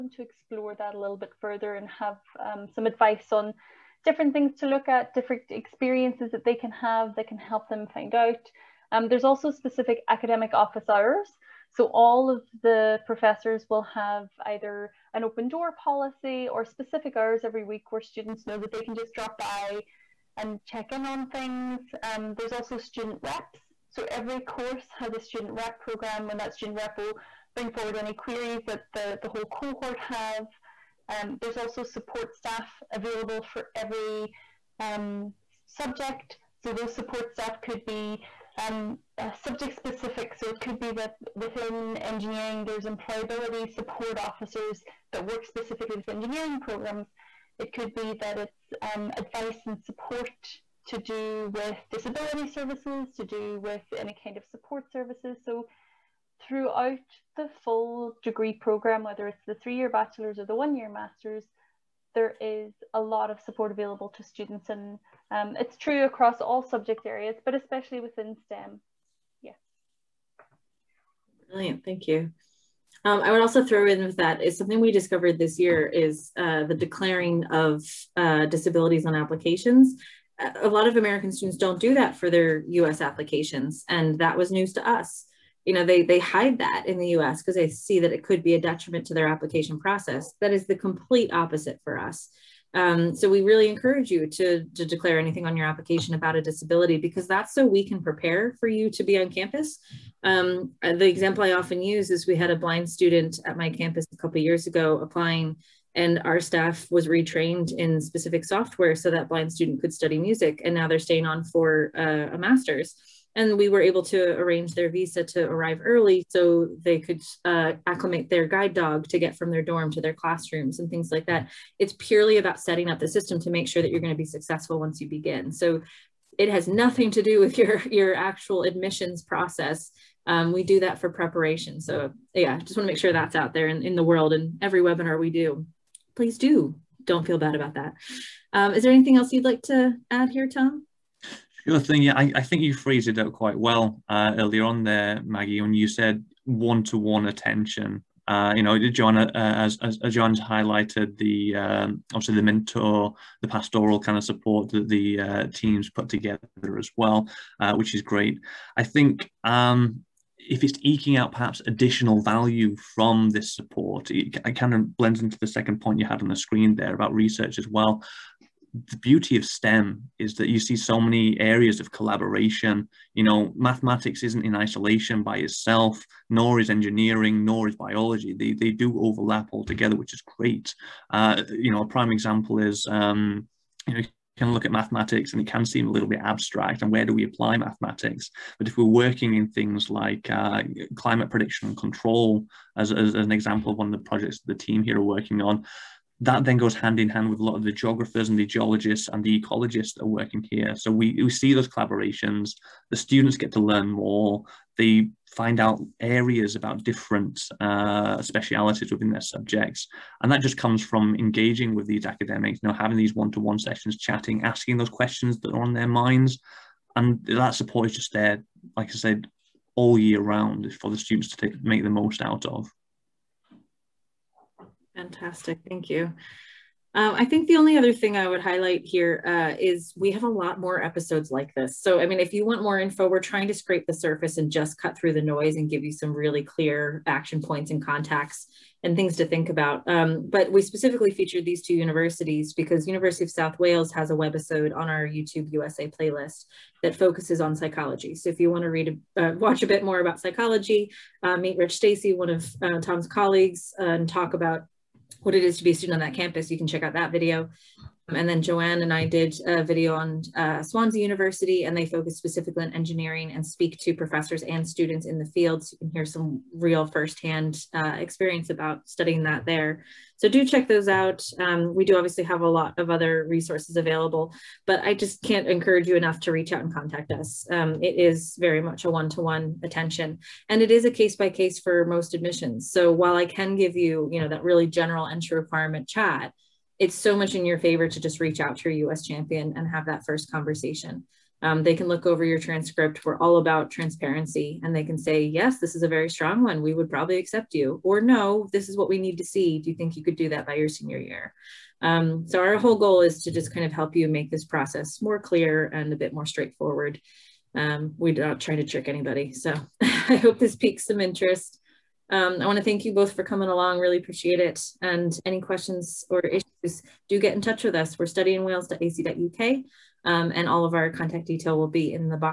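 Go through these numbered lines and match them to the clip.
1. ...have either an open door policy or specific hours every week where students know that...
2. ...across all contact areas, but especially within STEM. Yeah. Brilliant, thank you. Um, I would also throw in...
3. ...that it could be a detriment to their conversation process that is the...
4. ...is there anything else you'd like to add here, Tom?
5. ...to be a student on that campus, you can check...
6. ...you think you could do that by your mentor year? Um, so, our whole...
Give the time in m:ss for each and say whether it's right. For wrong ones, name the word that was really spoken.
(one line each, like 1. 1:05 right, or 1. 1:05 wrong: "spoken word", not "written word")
1. 0:13 right
2. 1:06 wrong: "subject", not "contact"
3. 1:27 wrong: "application", not "conversation"
4. 2:18 right
5. 4:15 right
6. 4:59 wrong: "senior", not "mentor".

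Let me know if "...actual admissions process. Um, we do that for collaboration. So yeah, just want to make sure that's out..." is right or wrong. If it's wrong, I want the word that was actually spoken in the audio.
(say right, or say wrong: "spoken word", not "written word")
wrong: "preparation", not "collaboration".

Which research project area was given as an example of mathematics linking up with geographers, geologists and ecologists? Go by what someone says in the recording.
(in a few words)
Climate prediction and control.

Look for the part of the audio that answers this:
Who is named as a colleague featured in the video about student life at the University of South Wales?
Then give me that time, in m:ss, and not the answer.
4:11.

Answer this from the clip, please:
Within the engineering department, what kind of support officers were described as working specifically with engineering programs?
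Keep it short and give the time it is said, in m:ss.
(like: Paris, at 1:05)
Employability support officers, at 0:42.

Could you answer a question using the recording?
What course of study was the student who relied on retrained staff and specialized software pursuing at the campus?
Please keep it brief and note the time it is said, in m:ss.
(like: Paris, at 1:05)
Music, at 1:50.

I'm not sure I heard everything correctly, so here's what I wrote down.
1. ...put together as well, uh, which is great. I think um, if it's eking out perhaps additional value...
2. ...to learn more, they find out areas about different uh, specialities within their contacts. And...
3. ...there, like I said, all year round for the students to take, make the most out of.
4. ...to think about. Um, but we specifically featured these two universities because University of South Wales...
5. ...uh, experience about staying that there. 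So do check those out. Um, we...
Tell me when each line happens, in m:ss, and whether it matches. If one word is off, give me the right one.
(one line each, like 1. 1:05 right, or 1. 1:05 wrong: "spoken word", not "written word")
1. 2:35 right
2. 3:23 wrong: "subjects", not "contacts"
3. 3:38 right
4. 3:59 right
5. 4:27 wrong: "studying", not "staying".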